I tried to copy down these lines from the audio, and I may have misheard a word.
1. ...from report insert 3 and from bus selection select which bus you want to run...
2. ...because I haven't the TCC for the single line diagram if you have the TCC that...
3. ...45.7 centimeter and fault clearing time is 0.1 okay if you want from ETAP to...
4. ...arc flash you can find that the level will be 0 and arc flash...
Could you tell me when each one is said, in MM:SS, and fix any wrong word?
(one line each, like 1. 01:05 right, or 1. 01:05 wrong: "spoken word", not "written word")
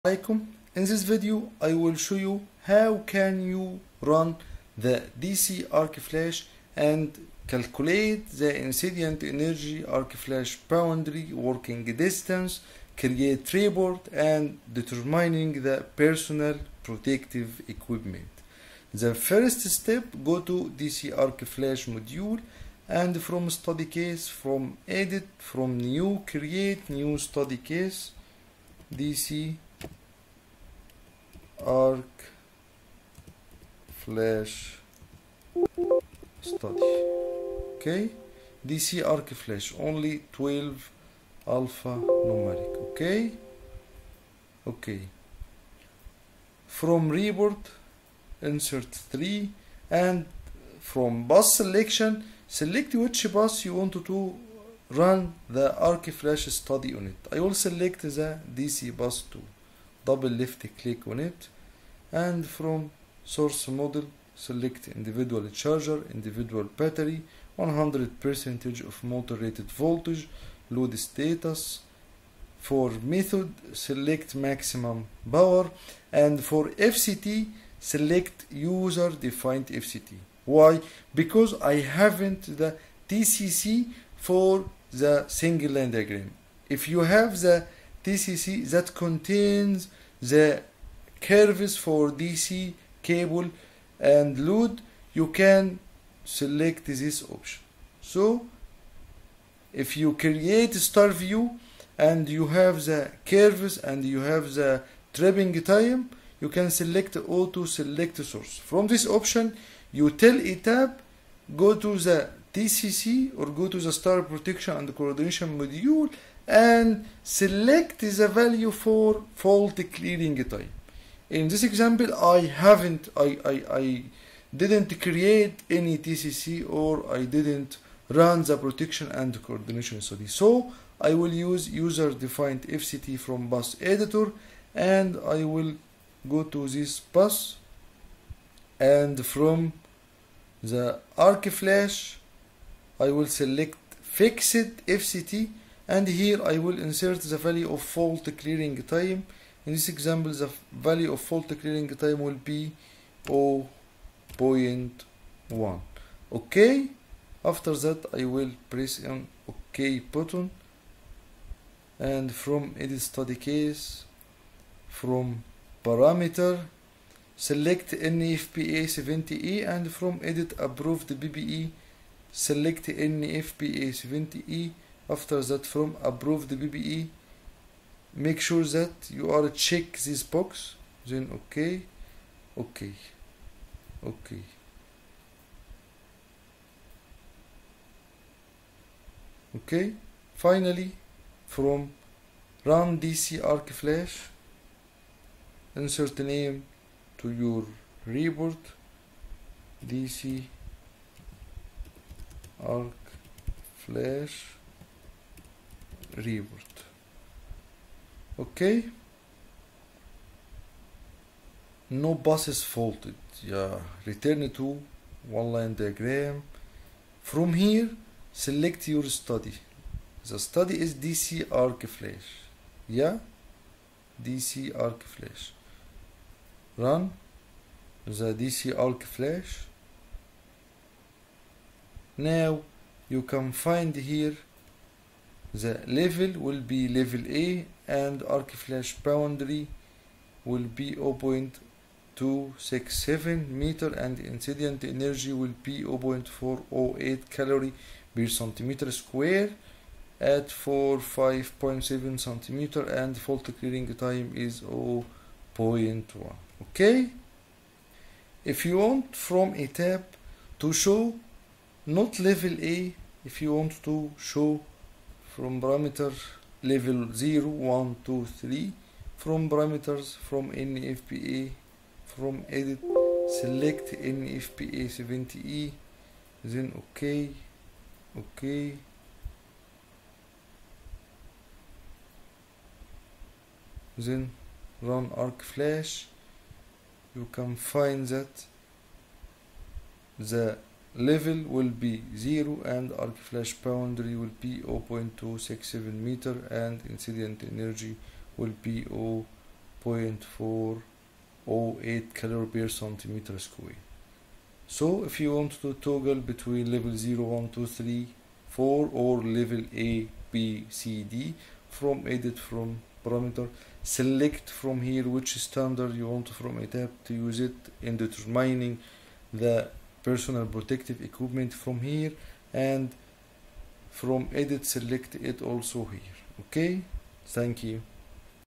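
1. 00:46 right
2. 01:21 right
3. 04:10 right
4. 04:45 right.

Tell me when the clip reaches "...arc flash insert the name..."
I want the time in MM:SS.
03:13.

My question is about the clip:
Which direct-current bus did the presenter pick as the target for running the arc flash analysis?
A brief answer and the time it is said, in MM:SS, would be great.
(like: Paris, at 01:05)
DC bus 2, at 00:58.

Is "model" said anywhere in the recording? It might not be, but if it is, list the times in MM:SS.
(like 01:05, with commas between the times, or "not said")
01:03.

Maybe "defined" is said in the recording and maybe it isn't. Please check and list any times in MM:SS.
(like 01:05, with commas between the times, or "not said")
01:19, 02:12.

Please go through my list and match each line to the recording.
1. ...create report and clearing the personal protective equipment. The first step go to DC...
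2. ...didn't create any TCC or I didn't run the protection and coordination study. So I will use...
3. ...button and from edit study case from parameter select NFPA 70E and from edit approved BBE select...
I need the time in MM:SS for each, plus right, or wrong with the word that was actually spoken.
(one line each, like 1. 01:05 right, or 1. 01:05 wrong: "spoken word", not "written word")
1. 00:12 wrong: "determining", not "clearing"
2. 02:04 right
3. 02:39 right.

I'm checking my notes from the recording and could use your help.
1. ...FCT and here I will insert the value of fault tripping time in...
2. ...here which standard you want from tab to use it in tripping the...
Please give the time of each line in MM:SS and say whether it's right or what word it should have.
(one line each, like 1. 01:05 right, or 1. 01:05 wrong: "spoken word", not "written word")
1. 02:24 wrong: "clearing", not "tripping"
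2. 05:14 wrong: "determining", not "tripping".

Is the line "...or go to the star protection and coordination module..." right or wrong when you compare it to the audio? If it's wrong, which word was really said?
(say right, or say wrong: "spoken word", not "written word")
right.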